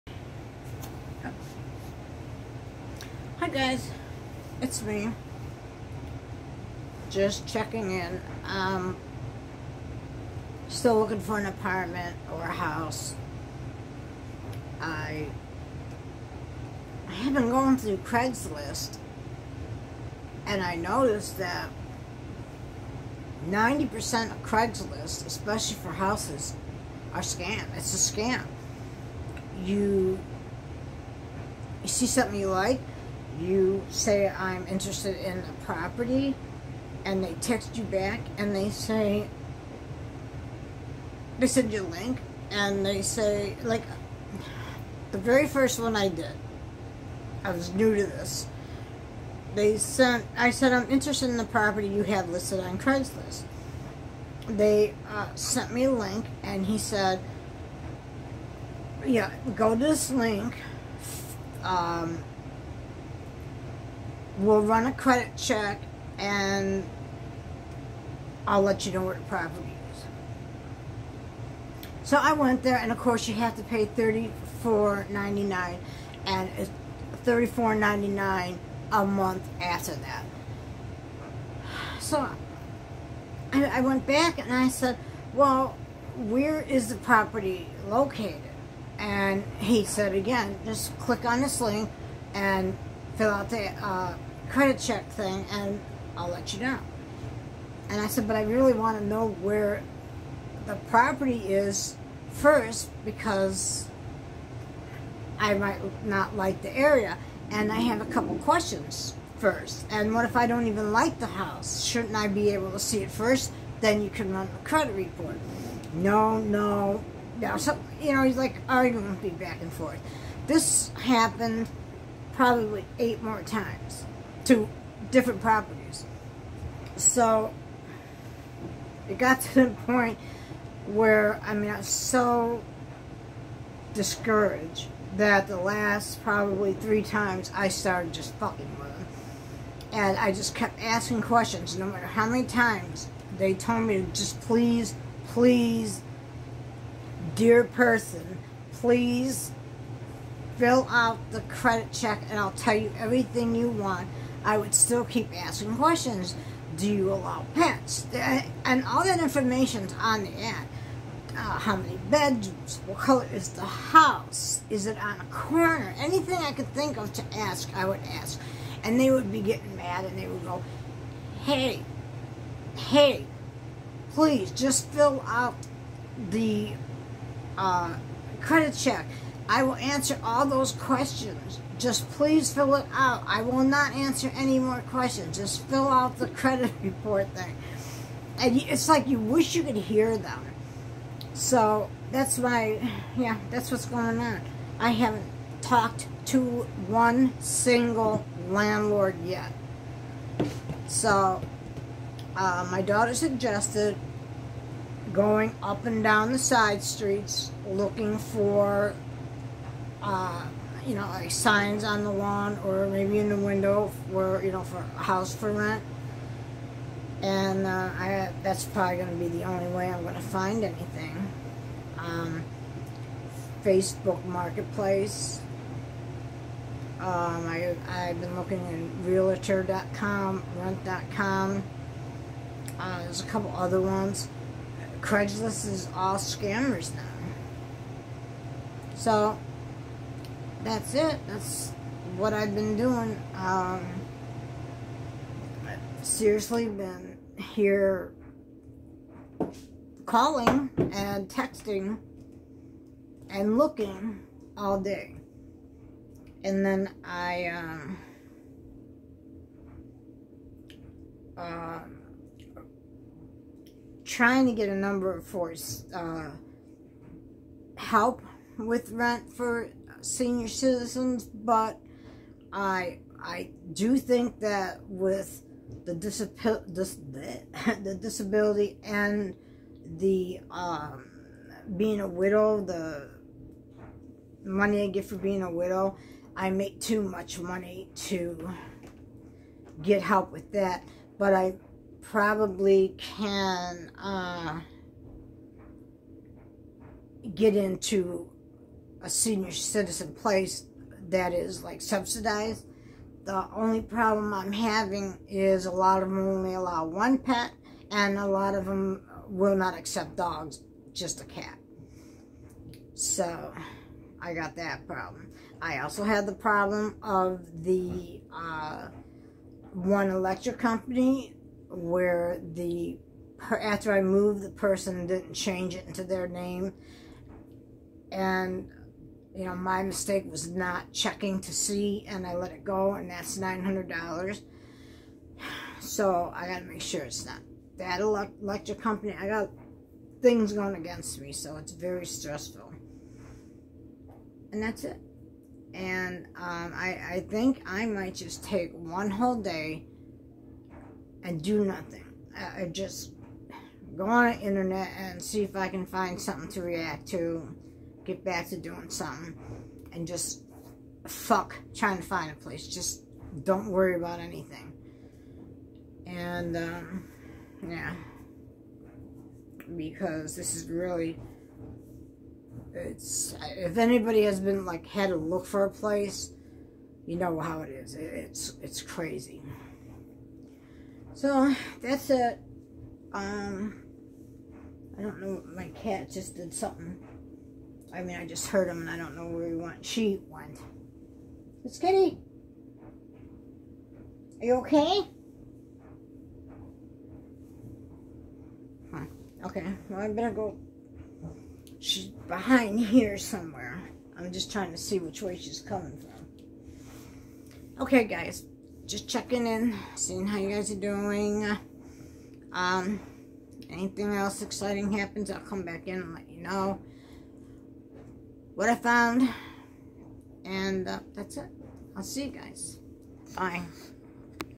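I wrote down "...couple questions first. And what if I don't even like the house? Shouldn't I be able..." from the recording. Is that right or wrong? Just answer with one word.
right.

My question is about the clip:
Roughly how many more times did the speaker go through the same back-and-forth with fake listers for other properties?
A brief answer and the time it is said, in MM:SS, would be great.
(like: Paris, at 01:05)
8, at 02:02.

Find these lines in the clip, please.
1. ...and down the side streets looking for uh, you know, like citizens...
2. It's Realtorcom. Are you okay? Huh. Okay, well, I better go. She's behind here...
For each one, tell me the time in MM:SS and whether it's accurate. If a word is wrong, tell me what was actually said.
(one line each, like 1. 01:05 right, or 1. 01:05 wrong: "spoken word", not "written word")
1. 03:25 wrong: "signs", not "citizens"
2. 06:31 wrong: "Kitty", not "Realtorcom".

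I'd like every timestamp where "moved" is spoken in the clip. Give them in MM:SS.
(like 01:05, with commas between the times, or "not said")
05:24.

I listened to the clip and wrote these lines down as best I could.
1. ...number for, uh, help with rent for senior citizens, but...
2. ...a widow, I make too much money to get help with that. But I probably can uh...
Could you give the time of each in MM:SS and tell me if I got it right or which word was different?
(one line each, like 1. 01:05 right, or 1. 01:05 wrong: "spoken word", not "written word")
1. 04:24 right
2. 04:45 right.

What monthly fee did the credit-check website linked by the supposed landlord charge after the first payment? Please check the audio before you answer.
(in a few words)
$34.99.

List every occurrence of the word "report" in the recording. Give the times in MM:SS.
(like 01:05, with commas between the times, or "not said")
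01:54, 03:06.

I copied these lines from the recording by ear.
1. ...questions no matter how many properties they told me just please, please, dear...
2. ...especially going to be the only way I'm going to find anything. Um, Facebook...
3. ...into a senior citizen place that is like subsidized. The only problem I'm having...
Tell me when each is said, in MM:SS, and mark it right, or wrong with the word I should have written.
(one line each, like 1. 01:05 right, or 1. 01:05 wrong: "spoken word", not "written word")
1. 02:21 wrong: "times", not "properties"
2. 03:38 wrong: "probably", not "especially"
3. 04:57 right.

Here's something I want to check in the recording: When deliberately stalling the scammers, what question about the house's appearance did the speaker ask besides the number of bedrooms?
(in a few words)
What color is the house.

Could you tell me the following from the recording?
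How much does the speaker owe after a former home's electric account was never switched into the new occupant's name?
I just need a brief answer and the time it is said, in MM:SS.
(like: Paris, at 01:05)
$900, at 05:33.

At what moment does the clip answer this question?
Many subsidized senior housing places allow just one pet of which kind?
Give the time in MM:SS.
05:10.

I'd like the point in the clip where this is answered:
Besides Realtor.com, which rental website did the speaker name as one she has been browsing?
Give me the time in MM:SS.
03:50.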